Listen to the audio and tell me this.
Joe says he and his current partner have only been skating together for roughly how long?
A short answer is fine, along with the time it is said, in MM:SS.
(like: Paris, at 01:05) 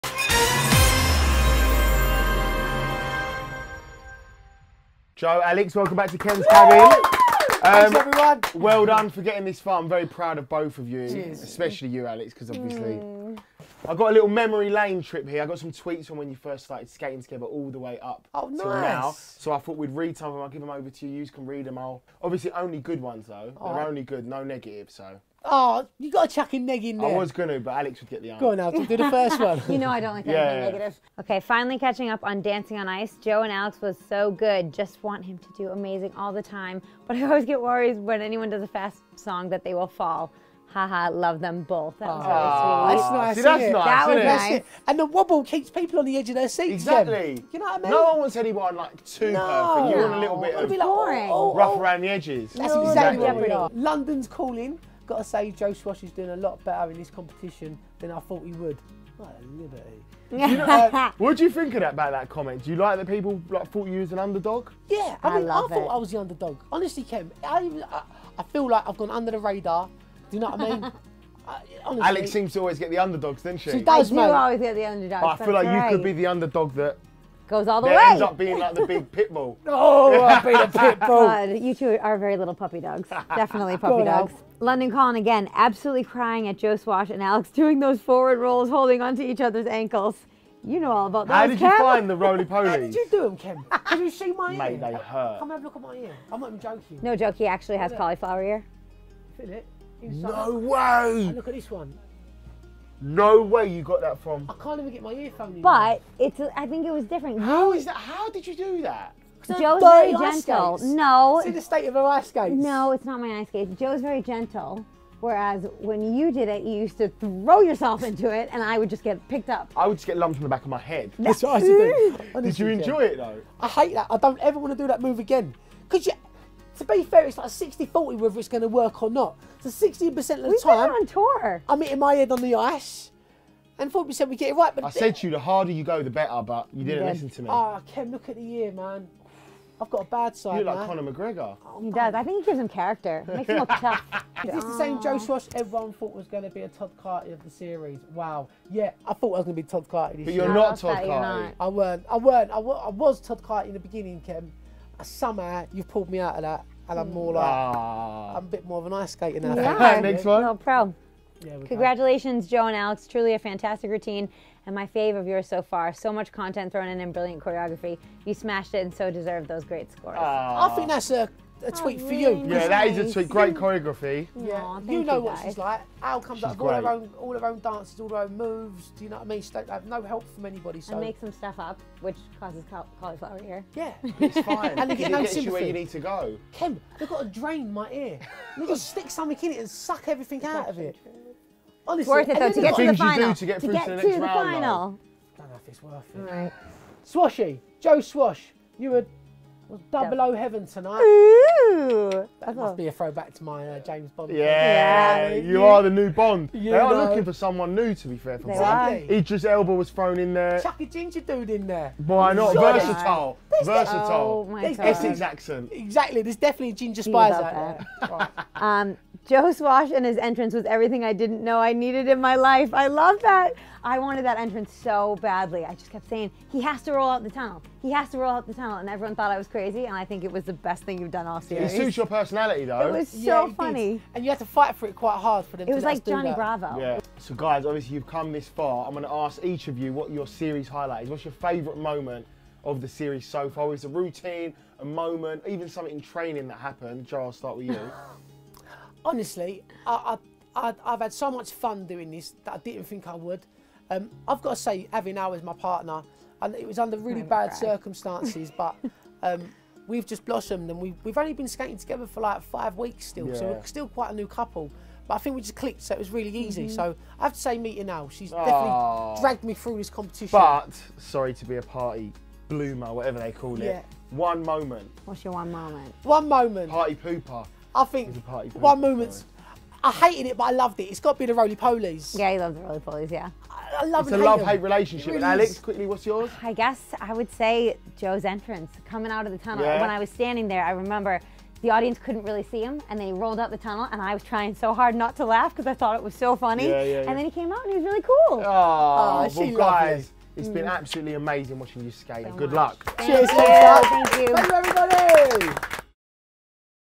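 5 weeks, at 04:22.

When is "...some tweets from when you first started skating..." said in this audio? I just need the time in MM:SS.
00:15.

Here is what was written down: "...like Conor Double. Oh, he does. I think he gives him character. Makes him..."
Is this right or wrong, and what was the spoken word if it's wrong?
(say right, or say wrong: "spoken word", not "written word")
wrong: "McGregor", not "Double".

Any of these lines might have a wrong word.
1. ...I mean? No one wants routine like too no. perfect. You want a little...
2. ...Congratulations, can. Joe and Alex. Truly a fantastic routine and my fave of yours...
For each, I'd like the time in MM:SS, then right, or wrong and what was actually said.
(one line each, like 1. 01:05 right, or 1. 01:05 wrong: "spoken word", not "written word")
1. 00:47 wrong: "anyone", not "routine"
2. 02:41 right.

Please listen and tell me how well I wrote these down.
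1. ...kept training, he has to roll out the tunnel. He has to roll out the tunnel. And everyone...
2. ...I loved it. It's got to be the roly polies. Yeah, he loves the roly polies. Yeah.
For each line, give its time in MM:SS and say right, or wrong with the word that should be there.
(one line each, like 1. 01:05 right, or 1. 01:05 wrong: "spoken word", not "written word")
1. 03:45 wrong: "saying", not "training"
2. 04:40 right.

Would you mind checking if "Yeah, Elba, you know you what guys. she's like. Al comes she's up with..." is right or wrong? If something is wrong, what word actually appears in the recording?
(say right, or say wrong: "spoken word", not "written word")
wrong: "Aww", not "Elba".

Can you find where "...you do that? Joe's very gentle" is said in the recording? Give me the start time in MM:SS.
01:48.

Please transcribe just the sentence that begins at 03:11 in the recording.
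Honestly, it's worth it though to get to the final.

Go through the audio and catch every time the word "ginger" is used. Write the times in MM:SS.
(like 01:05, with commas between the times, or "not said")
03:30, 03:36.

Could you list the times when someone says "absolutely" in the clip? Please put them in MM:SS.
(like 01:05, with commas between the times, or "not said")
01:25, 05:00.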